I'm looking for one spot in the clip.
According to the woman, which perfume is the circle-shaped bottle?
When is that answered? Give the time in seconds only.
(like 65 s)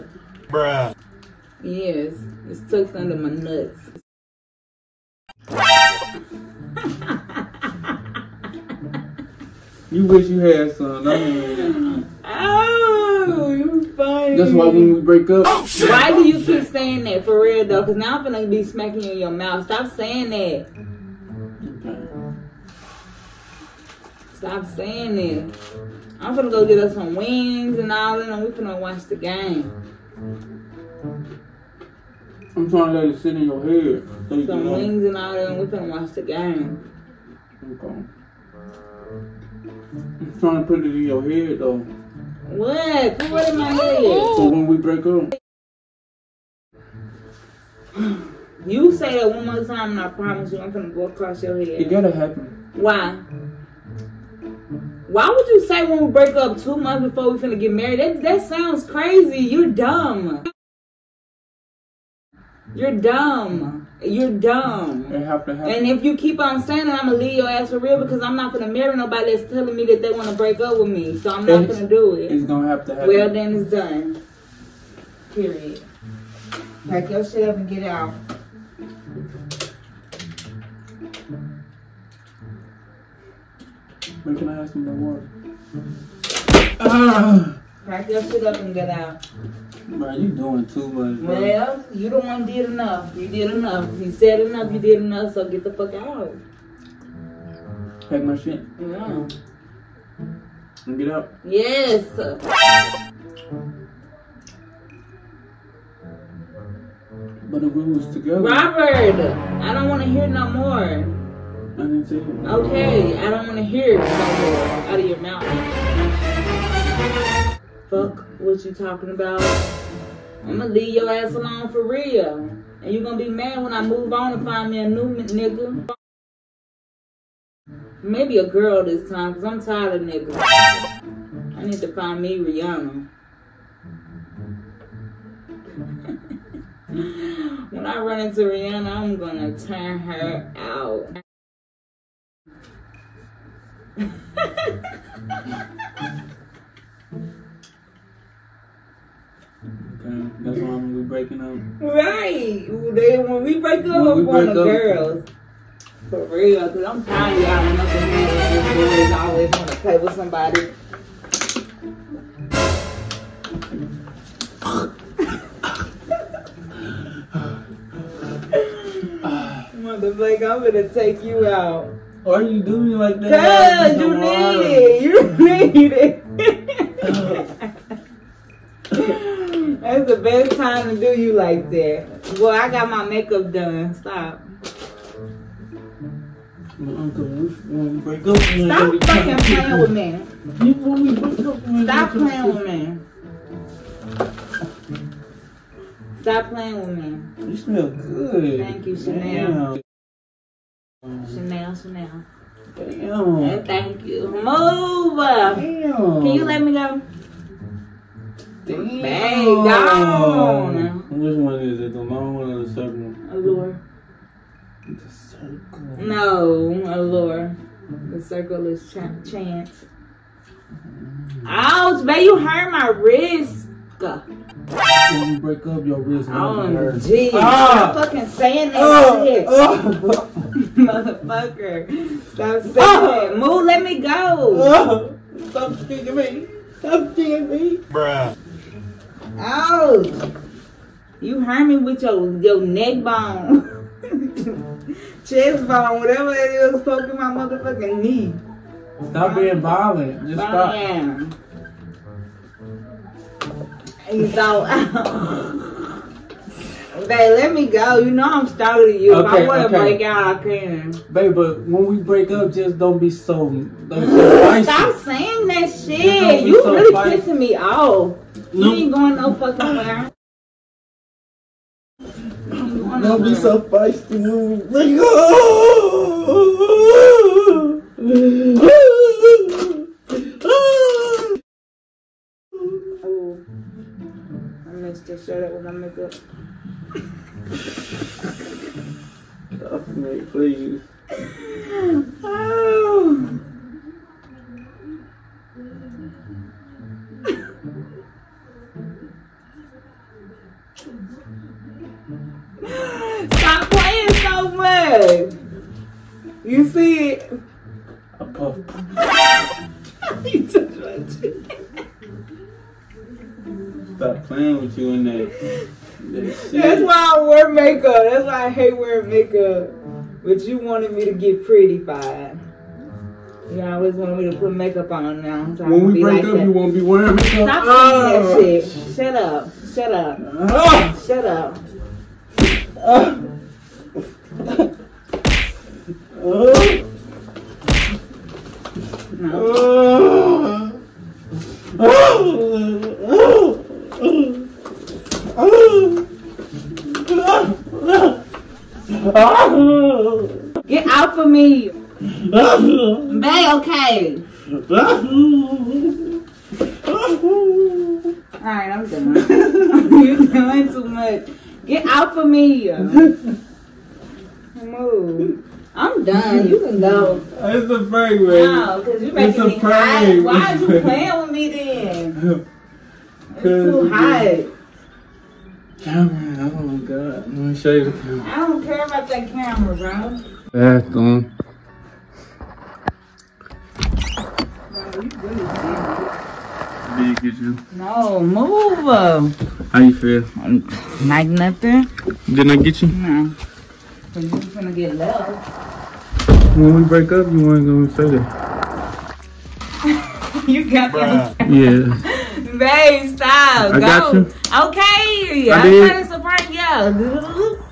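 219 s.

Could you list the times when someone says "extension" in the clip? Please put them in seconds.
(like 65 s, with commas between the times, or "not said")
not said.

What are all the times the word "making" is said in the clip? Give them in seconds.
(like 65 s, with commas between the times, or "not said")
369 s.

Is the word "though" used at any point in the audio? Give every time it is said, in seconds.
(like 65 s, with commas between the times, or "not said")
17 s, 41 s.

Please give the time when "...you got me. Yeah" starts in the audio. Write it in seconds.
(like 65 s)
400 s.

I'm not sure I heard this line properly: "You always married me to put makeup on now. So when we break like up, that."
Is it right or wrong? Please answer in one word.
wrong.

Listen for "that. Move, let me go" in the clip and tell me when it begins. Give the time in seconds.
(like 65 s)
233 s.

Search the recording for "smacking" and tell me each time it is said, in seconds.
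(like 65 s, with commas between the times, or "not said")
18 s.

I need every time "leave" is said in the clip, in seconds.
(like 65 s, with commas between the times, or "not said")
67 s, 120 s.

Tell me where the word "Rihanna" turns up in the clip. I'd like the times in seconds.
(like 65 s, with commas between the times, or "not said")
132 s, 138 s.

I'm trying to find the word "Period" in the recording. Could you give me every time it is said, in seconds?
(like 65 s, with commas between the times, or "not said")
75 s.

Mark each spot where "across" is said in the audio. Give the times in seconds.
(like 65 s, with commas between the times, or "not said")
51 s.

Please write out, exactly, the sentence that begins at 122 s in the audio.
And you gonna be mad when I move on and find me a new nigga.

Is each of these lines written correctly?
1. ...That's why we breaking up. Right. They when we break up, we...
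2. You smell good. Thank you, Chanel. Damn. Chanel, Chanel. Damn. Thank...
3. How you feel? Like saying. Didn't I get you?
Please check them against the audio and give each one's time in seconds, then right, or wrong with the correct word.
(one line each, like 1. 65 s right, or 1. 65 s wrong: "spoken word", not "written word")
1. 150 s right
2. 197 s right
3. 389 s wrong: "nothing", not "saying".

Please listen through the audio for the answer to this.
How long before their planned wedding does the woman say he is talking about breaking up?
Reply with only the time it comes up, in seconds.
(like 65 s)
56 s.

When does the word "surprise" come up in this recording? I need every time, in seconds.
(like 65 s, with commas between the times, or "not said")
406 s.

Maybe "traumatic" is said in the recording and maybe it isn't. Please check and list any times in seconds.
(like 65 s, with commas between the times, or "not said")
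not said.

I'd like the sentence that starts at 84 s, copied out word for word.
When can I ask him about water?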